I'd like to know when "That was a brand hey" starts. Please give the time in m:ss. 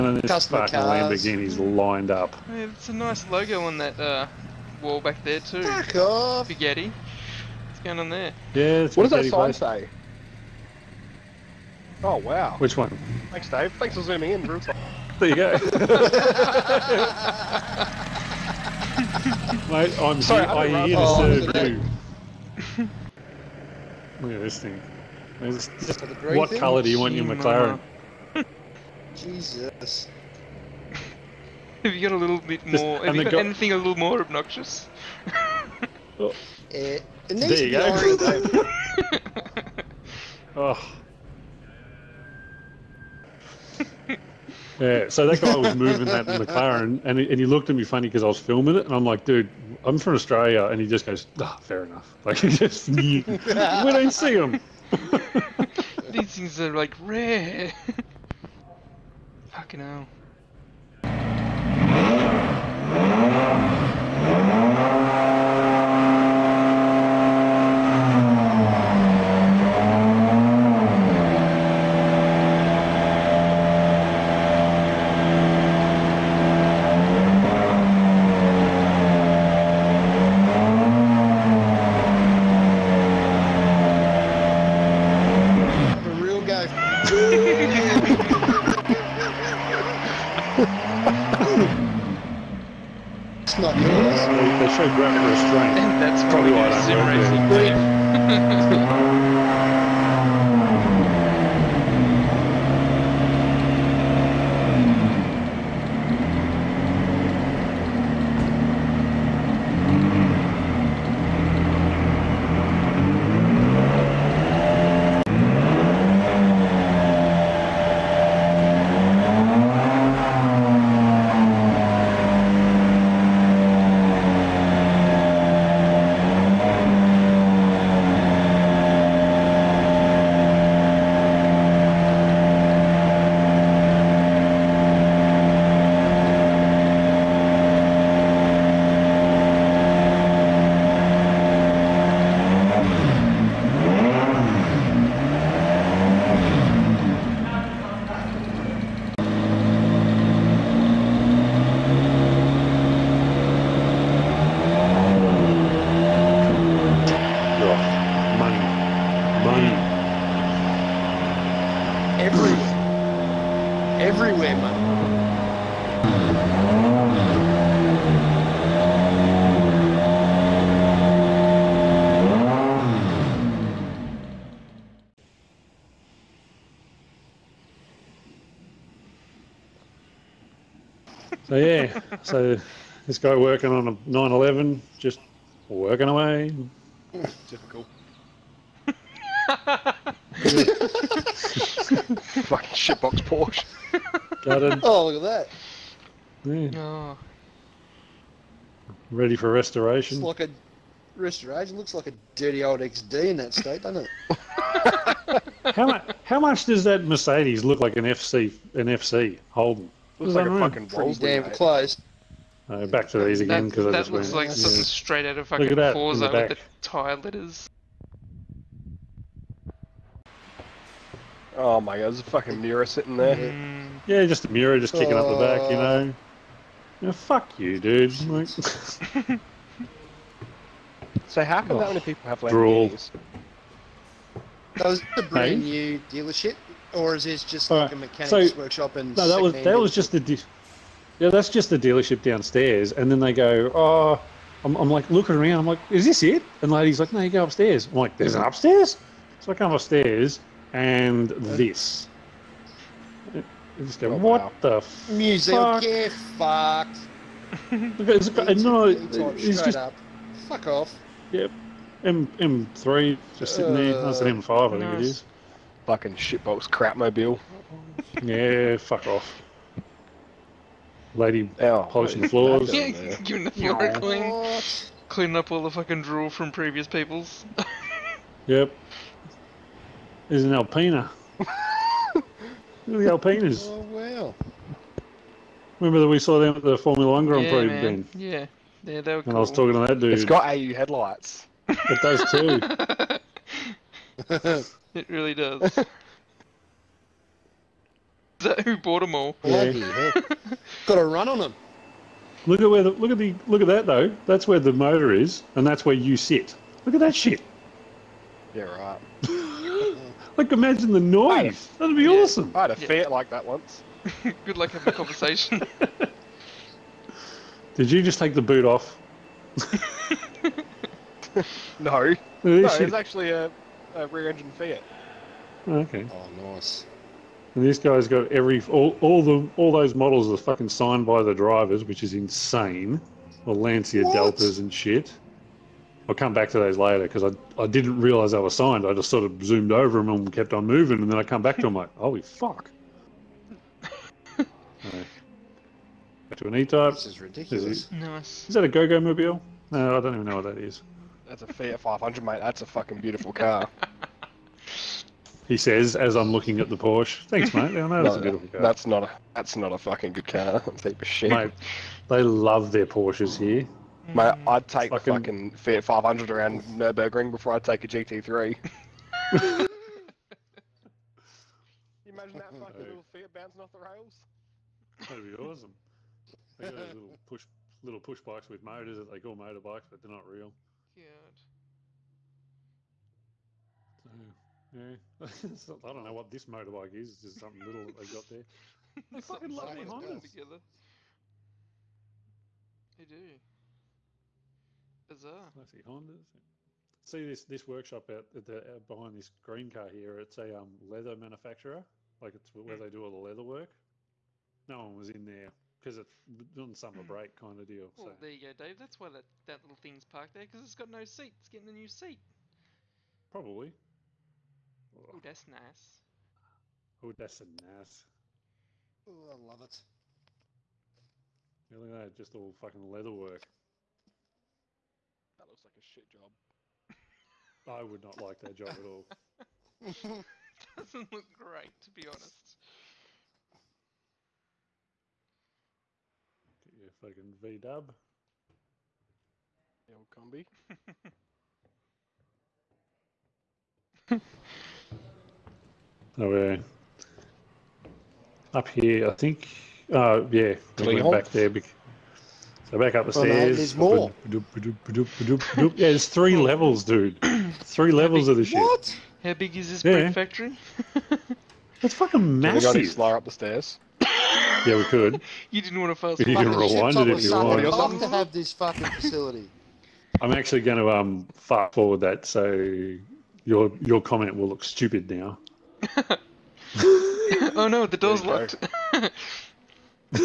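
3:54.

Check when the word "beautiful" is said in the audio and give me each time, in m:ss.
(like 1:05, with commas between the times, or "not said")
5:52, 5:58.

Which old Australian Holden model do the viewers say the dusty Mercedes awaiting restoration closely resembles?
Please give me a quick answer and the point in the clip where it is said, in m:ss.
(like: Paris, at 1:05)
FC Holden, at 3:28.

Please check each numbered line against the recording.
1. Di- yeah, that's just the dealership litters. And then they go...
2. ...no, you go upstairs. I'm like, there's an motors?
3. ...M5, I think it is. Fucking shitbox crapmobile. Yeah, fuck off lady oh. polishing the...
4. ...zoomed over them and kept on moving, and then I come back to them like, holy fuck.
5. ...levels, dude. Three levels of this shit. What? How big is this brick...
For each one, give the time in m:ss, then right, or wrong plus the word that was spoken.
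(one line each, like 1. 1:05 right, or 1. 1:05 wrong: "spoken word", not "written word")
1. 4:00 wrong: "downstairs", not "litters"
2. 4:07 wrong: "upstairs", not "motors"
3. 4:24 right
4. 5:39 right
5. 7:36 right.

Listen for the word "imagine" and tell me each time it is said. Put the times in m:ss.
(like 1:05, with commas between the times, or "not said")
5:10, 6:12.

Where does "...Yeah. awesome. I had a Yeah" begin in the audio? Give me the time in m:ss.
5:12.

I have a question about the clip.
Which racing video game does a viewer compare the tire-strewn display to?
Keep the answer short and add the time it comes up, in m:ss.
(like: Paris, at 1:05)
Forza, at 3:35.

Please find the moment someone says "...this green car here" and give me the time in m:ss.
6:39.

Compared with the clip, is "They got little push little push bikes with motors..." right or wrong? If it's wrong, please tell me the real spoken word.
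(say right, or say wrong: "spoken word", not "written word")
right.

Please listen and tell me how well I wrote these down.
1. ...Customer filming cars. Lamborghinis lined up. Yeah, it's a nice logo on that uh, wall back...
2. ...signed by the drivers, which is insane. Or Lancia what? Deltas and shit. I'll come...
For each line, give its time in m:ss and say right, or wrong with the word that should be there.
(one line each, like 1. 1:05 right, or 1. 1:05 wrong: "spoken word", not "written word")
1. 0:00 wrong: "sparkling", not "filming"
2. 5:30 right.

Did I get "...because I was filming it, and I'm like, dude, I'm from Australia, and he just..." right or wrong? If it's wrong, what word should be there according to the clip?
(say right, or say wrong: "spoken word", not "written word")
right.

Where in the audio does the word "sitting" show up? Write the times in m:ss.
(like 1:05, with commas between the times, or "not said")
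3:42, 4:23.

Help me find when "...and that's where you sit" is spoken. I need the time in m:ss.
5:05.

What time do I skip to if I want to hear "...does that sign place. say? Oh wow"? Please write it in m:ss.
0:09.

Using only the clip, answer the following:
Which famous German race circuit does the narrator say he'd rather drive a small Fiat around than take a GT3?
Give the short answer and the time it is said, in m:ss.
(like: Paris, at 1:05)
Nurburgring, at 6:06.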